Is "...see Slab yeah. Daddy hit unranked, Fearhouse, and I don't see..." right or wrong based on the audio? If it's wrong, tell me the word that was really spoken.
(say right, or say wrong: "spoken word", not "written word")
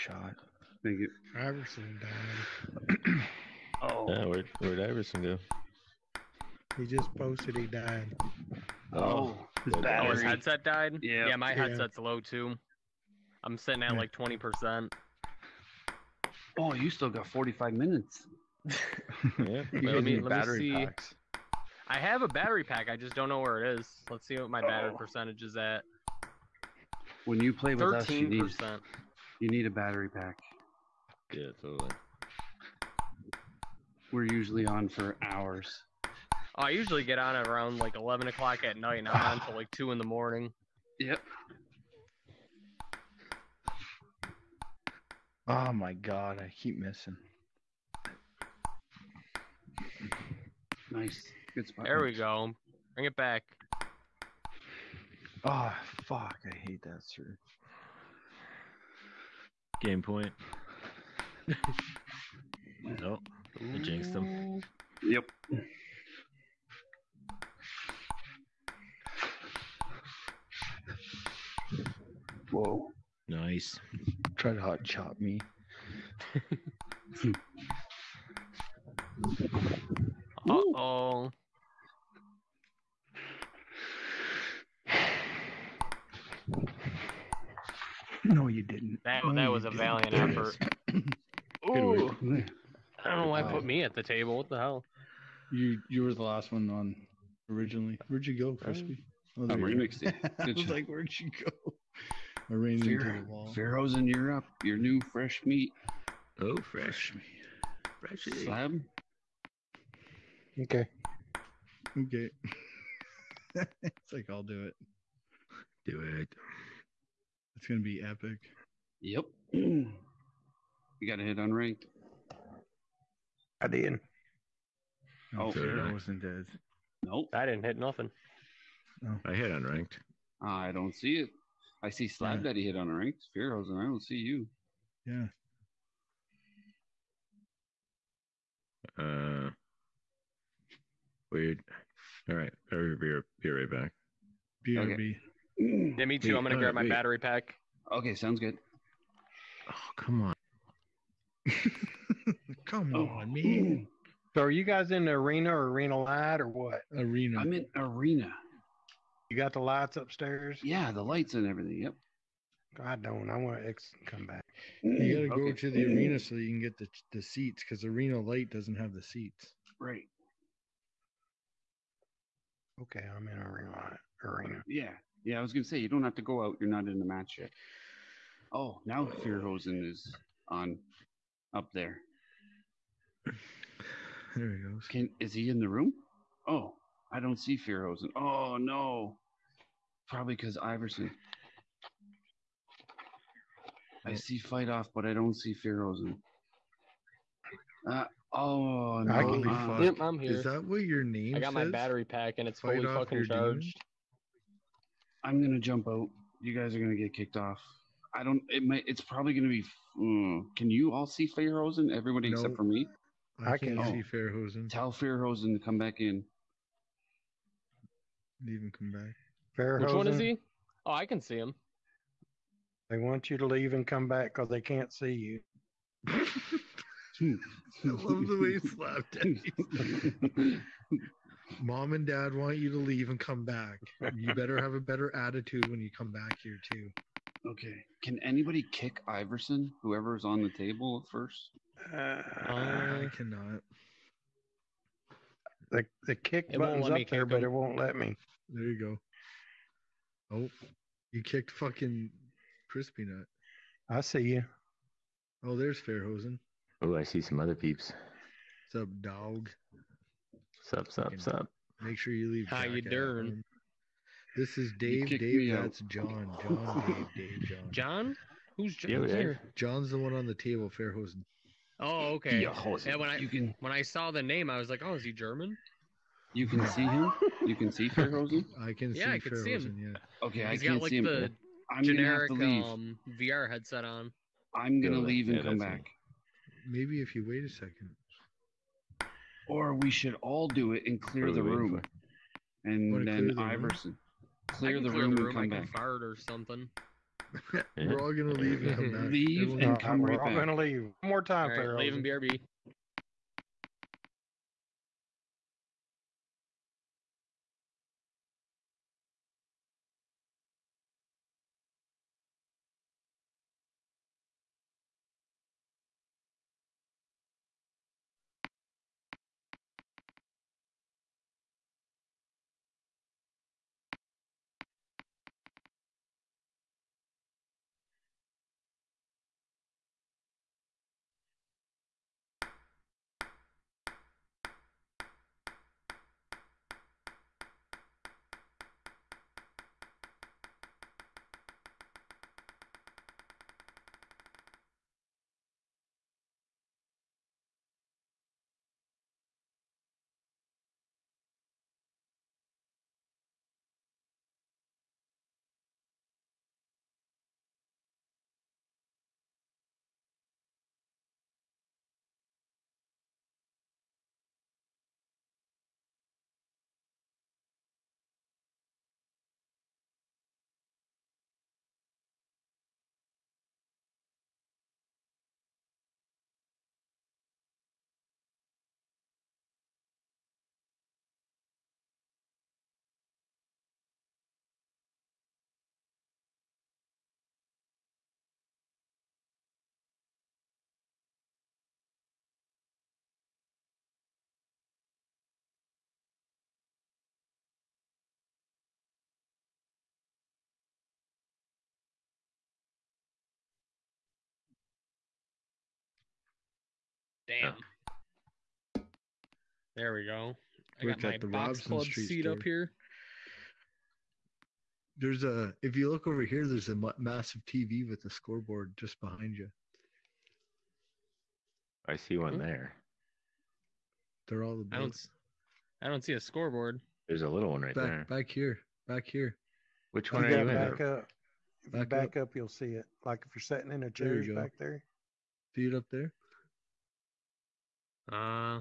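right.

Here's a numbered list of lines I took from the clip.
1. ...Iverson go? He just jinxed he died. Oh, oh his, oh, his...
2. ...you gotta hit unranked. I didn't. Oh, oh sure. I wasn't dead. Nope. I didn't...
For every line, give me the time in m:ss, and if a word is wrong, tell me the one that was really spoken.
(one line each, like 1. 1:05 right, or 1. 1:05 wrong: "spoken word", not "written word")
1. 0:04 wrong: "posted", not "jinxed"
2. 1:59 right.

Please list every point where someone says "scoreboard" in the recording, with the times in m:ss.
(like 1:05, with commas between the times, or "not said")
6:58, 7:06.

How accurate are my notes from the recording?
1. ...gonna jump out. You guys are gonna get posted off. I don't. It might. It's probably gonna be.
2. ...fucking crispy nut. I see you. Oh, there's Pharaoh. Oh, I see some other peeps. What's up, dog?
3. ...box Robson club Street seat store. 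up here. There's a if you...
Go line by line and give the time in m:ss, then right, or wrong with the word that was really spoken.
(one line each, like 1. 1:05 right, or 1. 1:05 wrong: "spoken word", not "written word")
1. 3:25 wrong: "kicked", not "posted"
2. 4:11 wrong: "Fairhosen", not "Pharaoh"
3. 6:51 right.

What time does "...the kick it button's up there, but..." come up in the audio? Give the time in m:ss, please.
4:06.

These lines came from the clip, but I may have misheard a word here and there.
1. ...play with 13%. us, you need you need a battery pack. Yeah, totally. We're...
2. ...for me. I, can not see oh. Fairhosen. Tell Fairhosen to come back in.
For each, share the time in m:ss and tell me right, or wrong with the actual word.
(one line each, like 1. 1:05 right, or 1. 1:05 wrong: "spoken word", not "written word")
1. 0:27 right
2. 3:32 right.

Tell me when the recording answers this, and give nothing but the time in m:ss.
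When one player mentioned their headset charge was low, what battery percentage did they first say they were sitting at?
0:13.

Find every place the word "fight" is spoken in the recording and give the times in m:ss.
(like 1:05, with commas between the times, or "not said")
3:14, 3:22.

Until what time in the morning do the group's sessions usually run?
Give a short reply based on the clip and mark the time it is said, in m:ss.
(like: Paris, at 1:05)
2 in the morning, at 0:39.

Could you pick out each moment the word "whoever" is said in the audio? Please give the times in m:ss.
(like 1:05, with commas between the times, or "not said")
3:59.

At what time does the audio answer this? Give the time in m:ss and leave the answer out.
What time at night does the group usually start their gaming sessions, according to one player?
0:37.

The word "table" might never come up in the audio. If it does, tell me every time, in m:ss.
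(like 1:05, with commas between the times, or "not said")
1:34, 4:00, 4:30.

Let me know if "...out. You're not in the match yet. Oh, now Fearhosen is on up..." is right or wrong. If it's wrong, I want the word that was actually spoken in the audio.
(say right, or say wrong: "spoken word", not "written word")
right.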